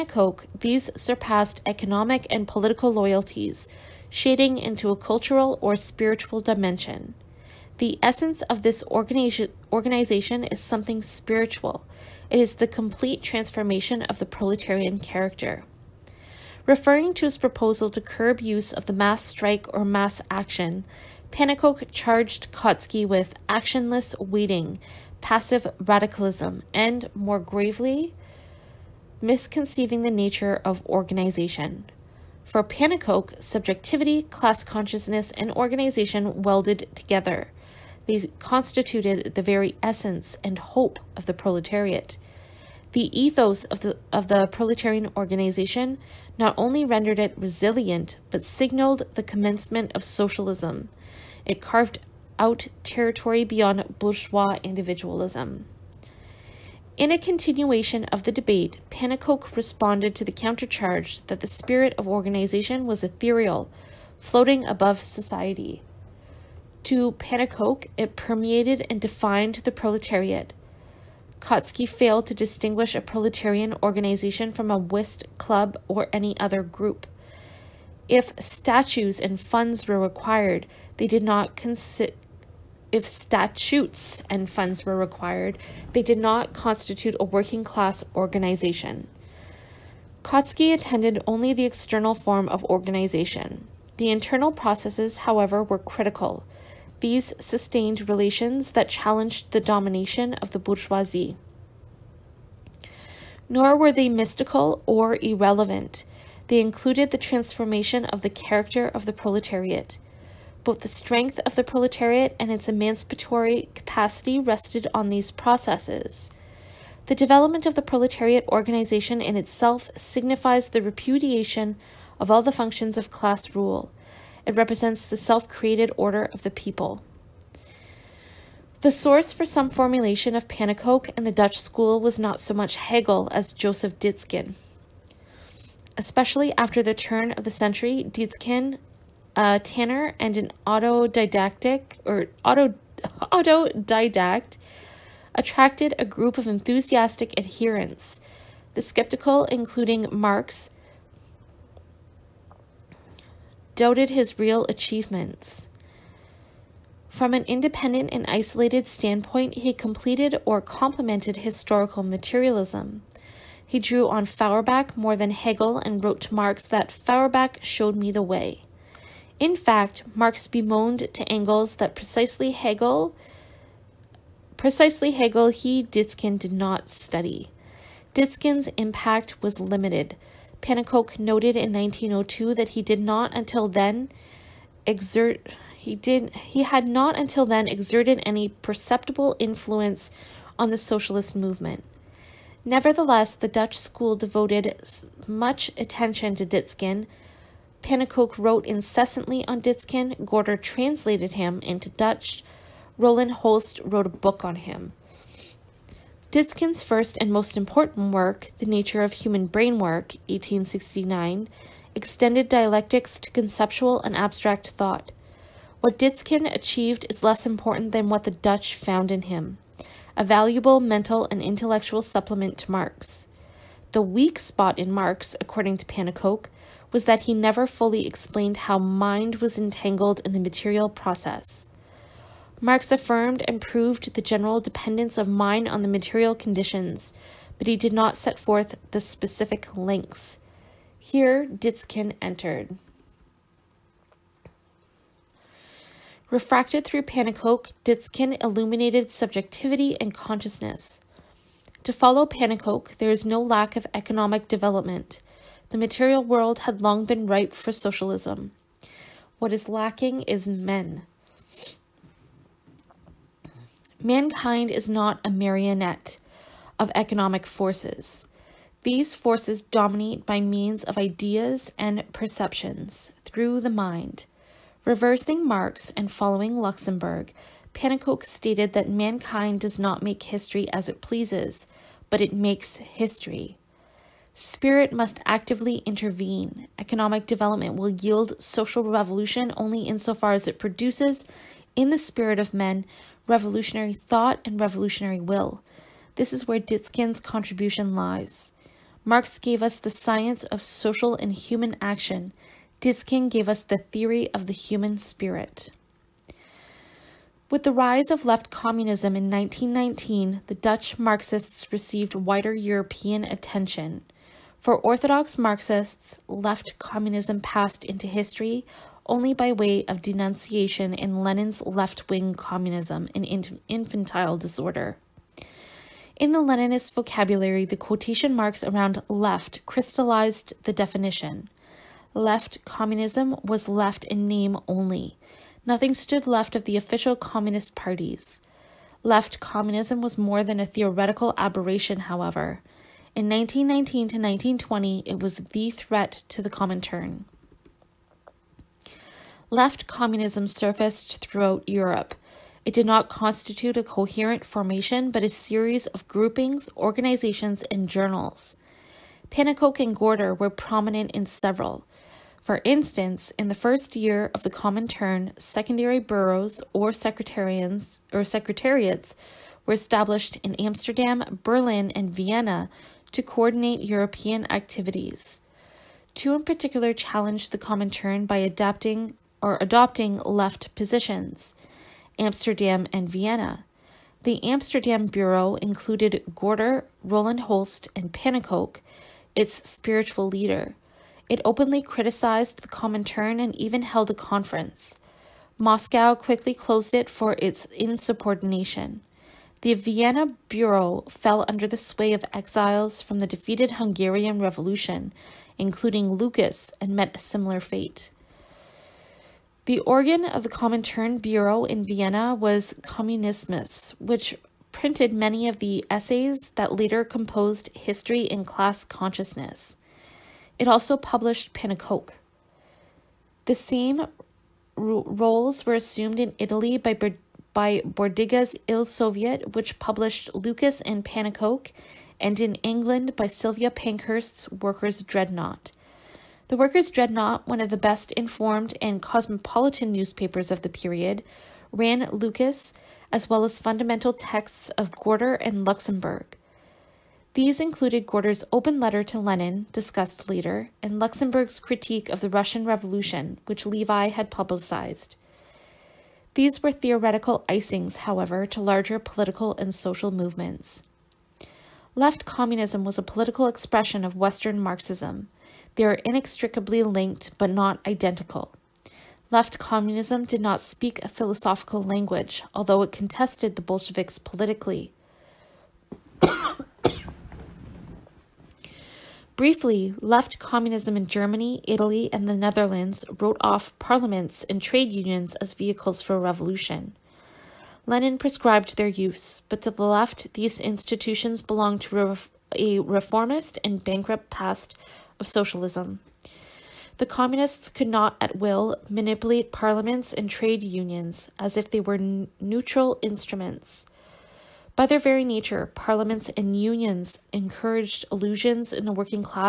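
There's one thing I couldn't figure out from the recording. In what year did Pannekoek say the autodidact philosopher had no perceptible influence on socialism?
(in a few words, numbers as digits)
1902.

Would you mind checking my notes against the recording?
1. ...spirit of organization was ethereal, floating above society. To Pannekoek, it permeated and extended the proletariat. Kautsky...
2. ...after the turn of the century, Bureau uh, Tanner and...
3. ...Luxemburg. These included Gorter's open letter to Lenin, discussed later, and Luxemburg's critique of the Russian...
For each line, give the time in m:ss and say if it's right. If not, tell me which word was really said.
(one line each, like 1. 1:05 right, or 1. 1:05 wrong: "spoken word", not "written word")
1. 1:01 wrong: "defined", not "extended"
2. 2:16 wrong: "Dietzgen", not "Bureau"
3. 7:25 right.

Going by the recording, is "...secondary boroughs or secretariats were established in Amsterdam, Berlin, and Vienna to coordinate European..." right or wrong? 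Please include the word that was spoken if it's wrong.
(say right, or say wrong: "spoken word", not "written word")
right.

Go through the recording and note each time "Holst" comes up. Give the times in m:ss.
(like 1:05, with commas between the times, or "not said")
3:23, 6:27.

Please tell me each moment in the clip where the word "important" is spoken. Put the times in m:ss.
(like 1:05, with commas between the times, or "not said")
3:27, 3:37.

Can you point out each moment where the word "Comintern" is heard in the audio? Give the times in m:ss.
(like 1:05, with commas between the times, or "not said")
5:46, 6:04, 6:17, 6:32, 6:50.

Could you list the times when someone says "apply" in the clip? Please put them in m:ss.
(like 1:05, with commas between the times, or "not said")
not said.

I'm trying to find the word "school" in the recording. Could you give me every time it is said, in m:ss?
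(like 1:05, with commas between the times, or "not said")
2:11, 3:13.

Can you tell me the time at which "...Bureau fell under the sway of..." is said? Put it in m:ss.
6:40.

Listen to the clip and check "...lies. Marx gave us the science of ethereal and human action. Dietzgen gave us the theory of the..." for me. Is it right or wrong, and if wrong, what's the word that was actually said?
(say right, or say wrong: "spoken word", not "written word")
wrong: "social", not "ethereal".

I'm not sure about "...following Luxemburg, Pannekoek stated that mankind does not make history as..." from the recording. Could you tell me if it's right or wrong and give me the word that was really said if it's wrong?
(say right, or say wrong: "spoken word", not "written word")
right.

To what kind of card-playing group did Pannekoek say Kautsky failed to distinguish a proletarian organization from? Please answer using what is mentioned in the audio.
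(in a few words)
whist club.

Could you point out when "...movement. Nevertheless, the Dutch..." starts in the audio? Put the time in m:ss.
3:11.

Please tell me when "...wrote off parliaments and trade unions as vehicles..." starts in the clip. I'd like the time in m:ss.
8:03.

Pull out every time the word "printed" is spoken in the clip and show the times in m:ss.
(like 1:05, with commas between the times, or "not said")
6:54.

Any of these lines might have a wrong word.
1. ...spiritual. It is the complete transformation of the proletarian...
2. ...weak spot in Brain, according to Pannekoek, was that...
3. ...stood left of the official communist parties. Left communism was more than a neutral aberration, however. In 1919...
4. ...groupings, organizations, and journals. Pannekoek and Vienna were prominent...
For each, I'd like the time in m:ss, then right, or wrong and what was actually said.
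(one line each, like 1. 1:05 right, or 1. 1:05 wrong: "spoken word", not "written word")
1. 0:11 right
2. 3:44 wrong: "Marx", not "Brain"
3. 5:35 wrong: "theoretical", not "neutral"
4. 5:56 wrong: "Gorter", not "Vienna".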